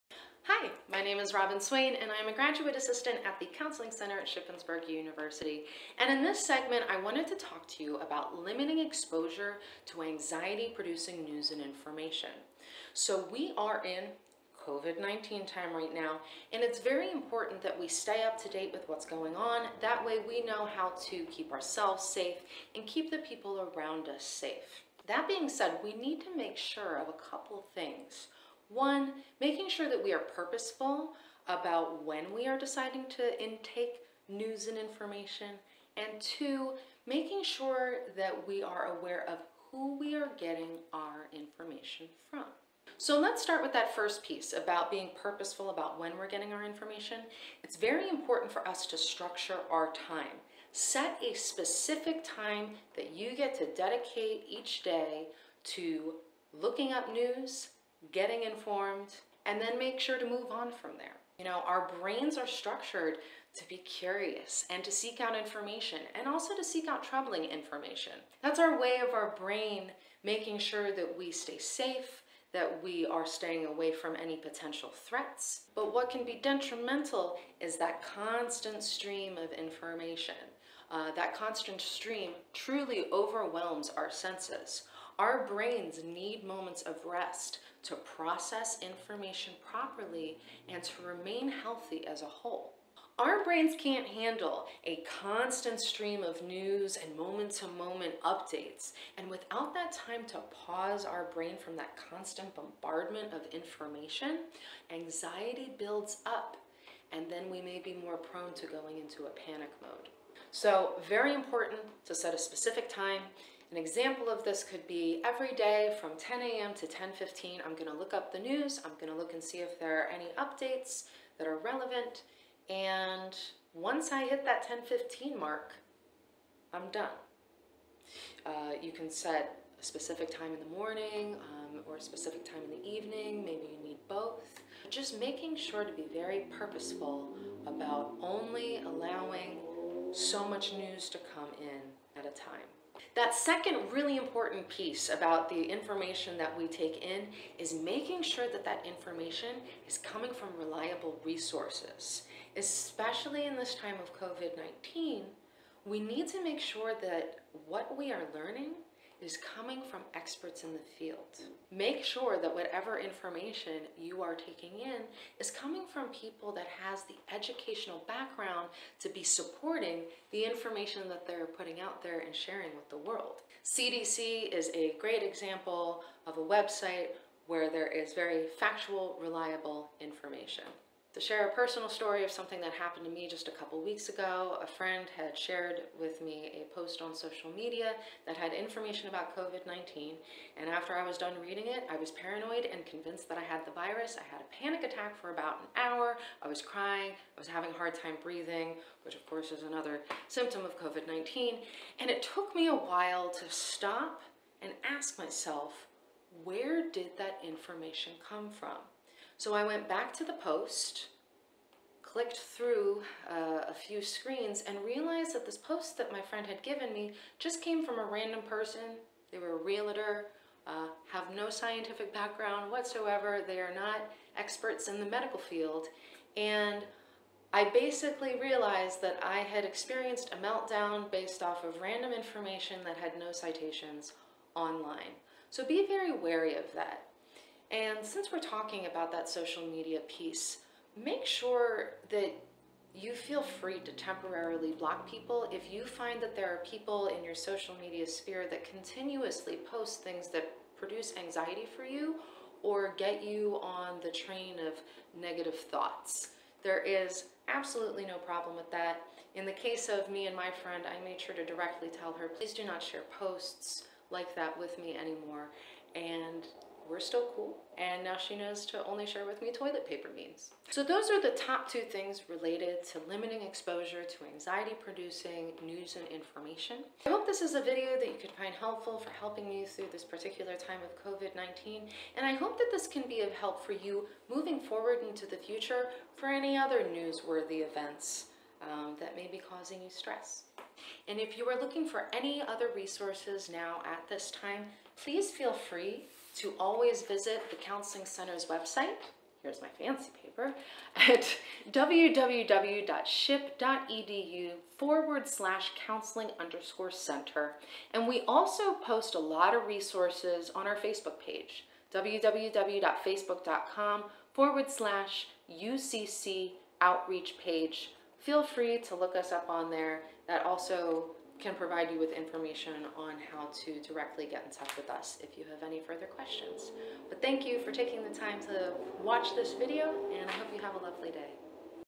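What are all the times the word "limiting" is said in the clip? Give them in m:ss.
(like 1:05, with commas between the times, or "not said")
0:08, 4:33.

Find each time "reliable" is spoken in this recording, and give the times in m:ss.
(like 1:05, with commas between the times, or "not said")
2:30, 2:59.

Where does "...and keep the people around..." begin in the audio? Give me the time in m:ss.
0:22.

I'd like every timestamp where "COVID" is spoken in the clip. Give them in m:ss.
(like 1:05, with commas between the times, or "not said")
0:14, 2:34, 3:09, 3:20, 4:41.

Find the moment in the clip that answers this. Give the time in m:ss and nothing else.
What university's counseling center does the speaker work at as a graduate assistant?
0:04.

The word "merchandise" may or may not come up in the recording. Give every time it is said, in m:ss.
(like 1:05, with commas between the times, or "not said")
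not said.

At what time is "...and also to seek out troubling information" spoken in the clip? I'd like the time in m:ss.
1:06.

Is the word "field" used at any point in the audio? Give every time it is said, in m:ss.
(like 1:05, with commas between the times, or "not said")
2:40, 3:45.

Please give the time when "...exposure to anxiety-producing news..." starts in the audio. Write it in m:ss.
0:08.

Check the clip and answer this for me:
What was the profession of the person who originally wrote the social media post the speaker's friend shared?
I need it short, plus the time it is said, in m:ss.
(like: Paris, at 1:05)
Realtor, at 3:39.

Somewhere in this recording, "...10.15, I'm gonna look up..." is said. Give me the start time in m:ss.
1:56.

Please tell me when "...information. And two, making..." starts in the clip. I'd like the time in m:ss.
0:34.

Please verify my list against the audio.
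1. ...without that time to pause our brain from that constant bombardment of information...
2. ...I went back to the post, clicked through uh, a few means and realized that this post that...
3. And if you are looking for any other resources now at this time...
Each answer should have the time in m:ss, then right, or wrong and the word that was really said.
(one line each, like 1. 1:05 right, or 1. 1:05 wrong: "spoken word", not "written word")
1. 1:39 right
2. 3:29 wrong: "screens", not "means"
3. 4:51 right.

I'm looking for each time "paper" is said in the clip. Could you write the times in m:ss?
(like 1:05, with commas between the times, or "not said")
4:29, 5:00.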